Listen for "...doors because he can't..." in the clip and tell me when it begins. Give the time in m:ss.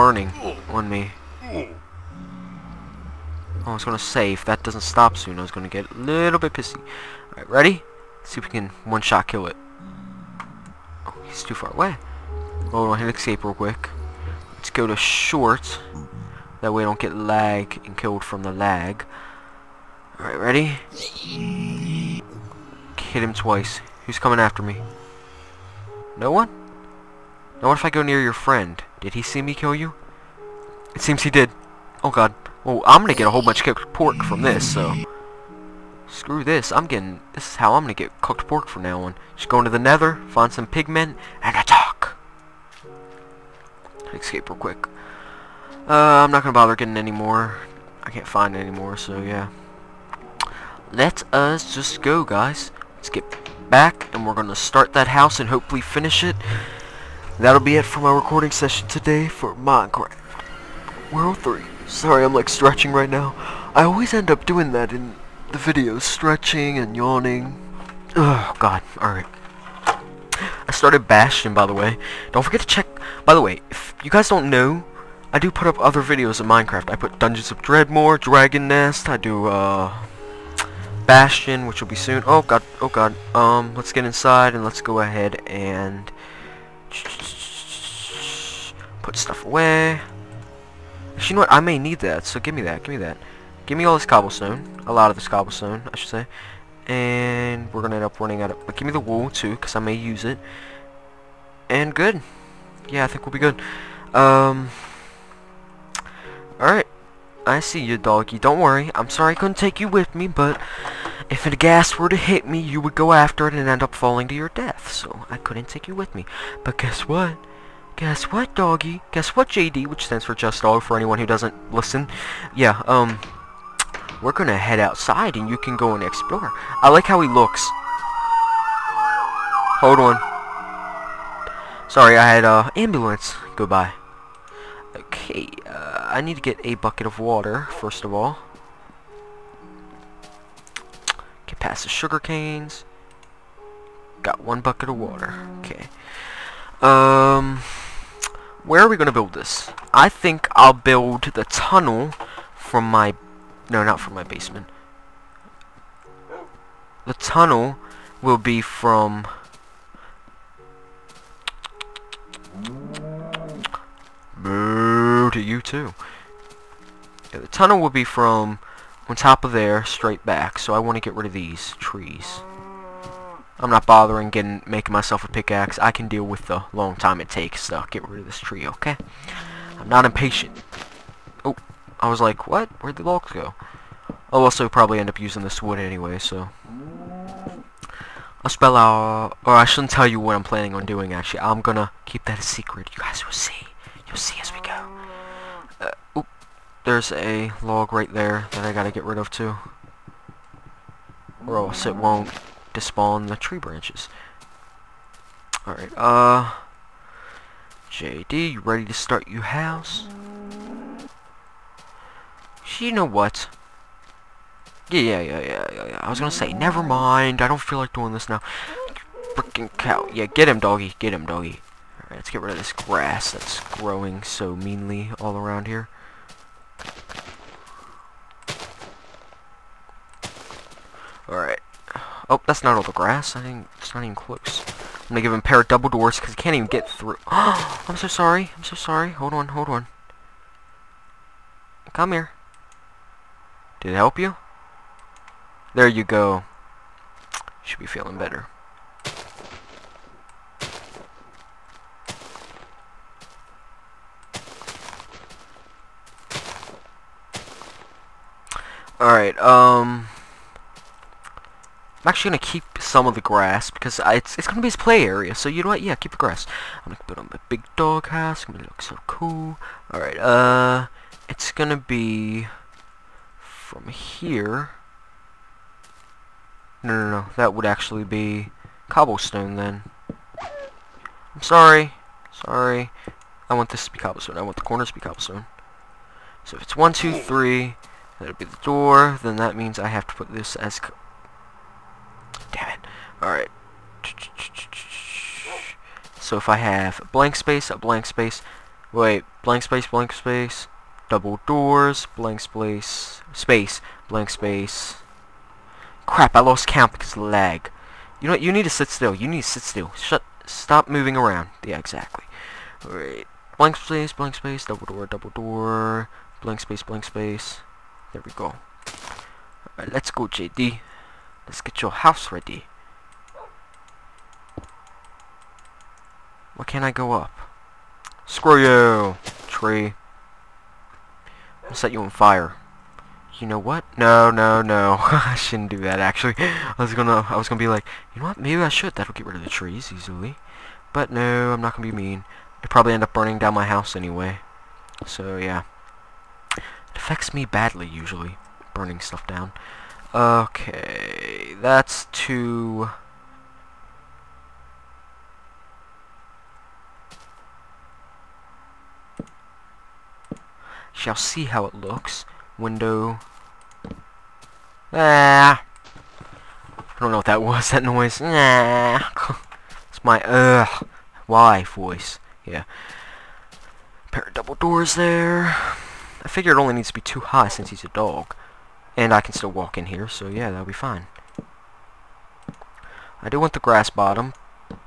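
3:55.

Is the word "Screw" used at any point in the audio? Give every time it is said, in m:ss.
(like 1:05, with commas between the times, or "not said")
0:36, 5:28.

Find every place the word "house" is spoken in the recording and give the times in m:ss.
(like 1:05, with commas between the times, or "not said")
0:55, 3:29, 4:28, 5:21, 5:43.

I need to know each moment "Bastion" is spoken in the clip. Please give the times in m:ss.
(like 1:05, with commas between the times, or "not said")
1:11, 1:21.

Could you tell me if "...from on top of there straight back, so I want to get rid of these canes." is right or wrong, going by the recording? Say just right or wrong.
wrong.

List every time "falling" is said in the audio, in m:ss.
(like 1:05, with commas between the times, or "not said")
1:53.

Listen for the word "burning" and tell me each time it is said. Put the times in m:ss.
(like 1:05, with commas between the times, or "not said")
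5:43, 5:48.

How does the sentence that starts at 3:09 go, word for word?
Or I shouldn't tell you what I'm planning on doing, actually.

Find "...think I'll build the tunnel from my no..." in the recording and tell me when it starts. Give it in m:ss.
2:30.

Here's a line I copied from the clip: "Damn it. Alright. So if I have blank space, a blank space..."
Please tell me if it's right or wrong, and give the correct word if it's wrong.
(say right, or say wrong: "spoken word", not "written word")
right.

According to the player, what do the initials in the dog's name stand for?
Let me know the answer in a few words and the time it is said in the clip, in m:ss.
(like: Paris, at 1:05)
Just dog, at 2:00.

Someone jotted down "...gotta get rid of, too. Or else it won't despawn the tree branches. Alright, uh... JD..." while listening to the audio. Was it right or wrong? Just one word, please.
right.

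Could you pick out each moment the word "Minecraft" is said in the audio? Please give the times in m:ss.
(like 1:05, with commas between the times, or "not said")
0:59, 1:16.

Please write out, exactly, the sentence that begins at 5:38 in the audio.
That'll get rid of the trees easily.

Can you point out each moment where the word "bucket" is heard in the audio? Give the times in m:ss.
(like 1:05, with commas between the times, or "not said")
2:16, 2:24.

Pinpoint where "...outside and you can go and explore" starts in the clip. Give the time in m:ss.
2:04.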